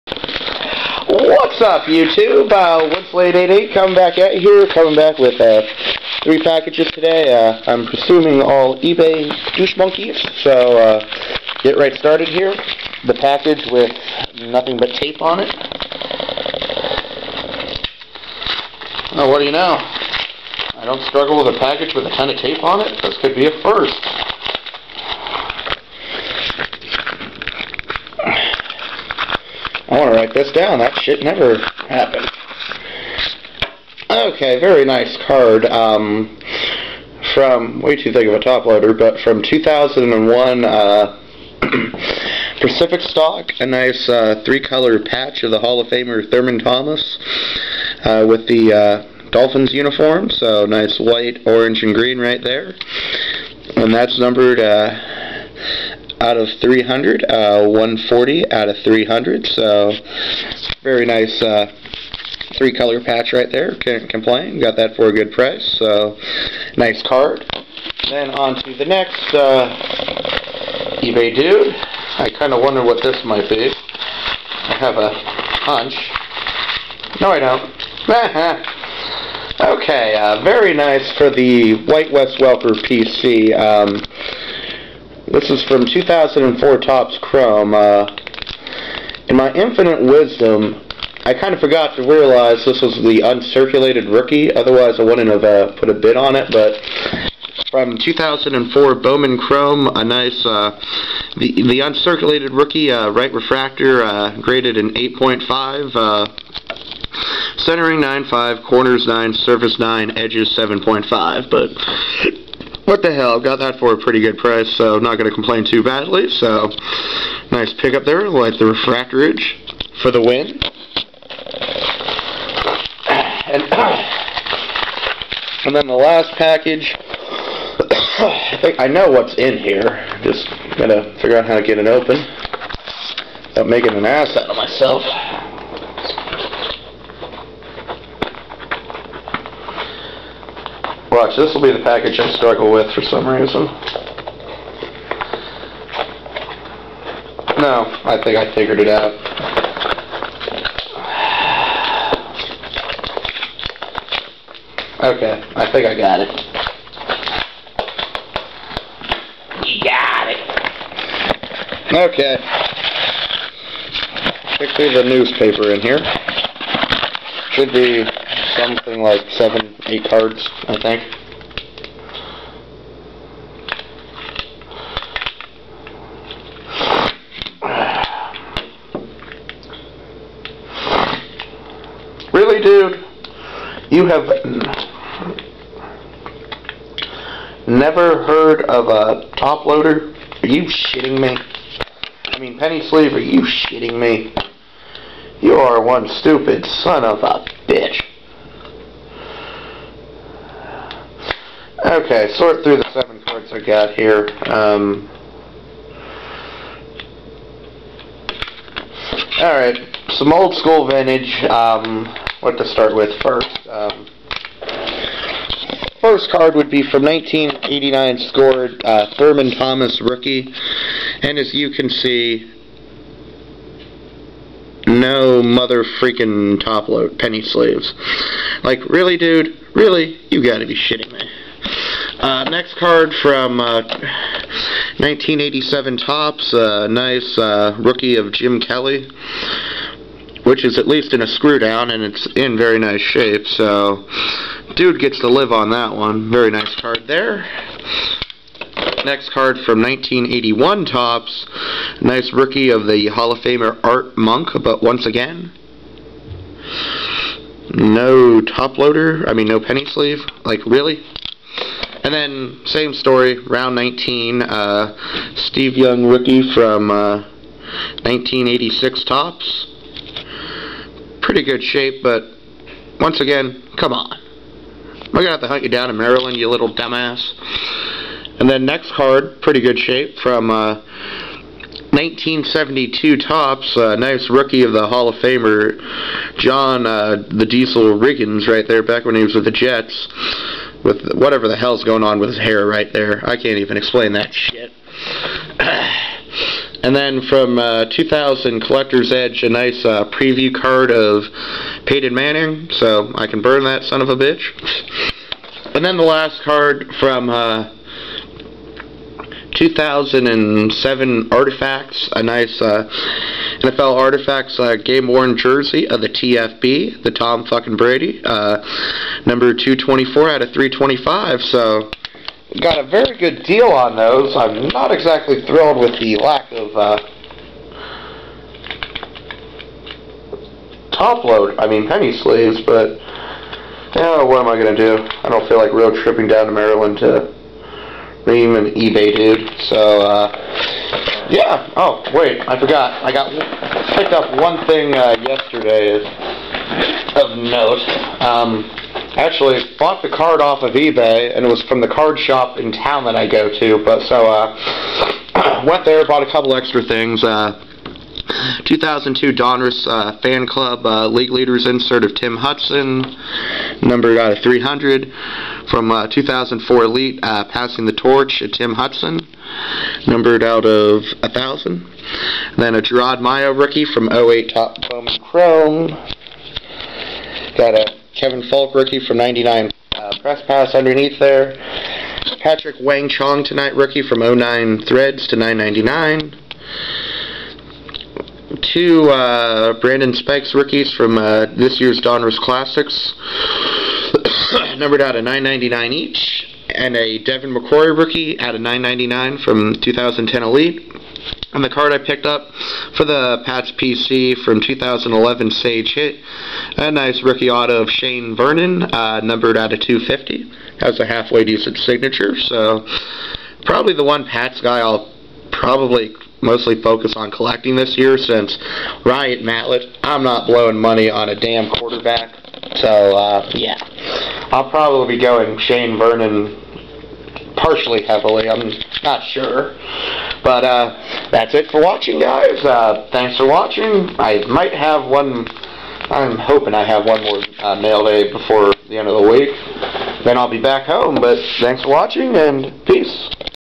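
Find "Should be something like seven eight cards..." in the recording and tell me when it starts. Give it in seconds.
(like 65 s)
167 s.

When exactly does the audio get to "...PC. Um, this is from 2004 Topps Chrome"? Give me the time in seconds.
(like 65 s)
82 s.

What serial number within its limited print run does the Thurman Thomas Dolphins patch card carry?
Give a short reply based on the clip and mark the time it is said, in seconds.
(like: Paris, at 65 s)
140 out of 300, at 57 s.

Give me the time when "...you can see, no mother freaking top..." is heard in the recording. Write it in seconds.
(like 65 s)
221 s.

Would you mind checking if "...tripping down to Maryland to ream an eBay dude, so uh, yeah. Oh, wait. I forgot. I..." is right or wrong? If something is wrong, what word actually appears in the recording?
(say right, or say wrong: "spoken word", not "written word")
right.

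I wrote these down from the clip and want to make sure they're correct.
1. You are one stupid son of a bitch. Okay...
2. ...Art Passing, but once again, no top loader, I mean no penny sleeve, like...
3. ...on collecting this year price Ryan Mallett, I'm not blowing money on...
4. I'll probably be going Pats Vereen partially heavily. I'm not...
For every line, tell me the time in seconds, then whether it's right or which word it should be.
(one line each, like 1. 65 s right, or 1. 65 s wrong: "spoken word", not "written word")
1. 195 s right
2. 253 s wrong: "Monk", not "Passing"
3. 417 s wrong: "since", not "price"
4. 424 s wrong: "Shane", not "Pats".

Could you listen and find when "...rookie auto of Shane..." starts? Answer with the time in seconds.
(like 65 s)
407 s.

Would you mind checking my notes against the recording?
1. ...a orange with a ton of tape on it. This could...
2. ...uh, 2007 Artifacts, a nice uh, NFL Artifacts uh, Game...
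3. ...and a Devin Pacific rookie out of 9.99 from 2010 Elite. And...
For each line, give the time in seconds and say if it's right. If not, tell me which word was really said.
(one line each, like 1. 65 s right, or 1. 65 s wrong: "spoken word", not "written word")
1. 21 s wrong: "package", not "orange"
2. 307 s right
3. 396 s wrong: "McCourty", not "Pacific".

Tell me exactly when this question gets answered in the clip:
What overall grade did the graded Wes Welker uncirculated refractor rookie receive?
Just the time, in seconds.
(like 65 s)
104 s.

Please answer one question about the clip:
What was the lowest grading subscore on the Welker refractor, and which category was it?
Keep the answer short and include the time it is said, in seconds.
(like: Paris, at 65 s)
Edges 7.5, at 110 s.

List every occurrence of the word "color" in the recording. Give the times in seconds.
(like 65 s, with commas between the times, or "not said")
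44 s, 62 s.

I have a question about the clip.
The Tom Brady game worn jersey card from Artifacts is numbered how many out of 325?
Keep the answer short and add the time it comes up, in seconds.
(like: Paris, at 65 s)
224, at 319 s.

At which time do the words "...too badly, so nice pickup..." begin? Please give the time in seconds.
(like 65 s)
115 s.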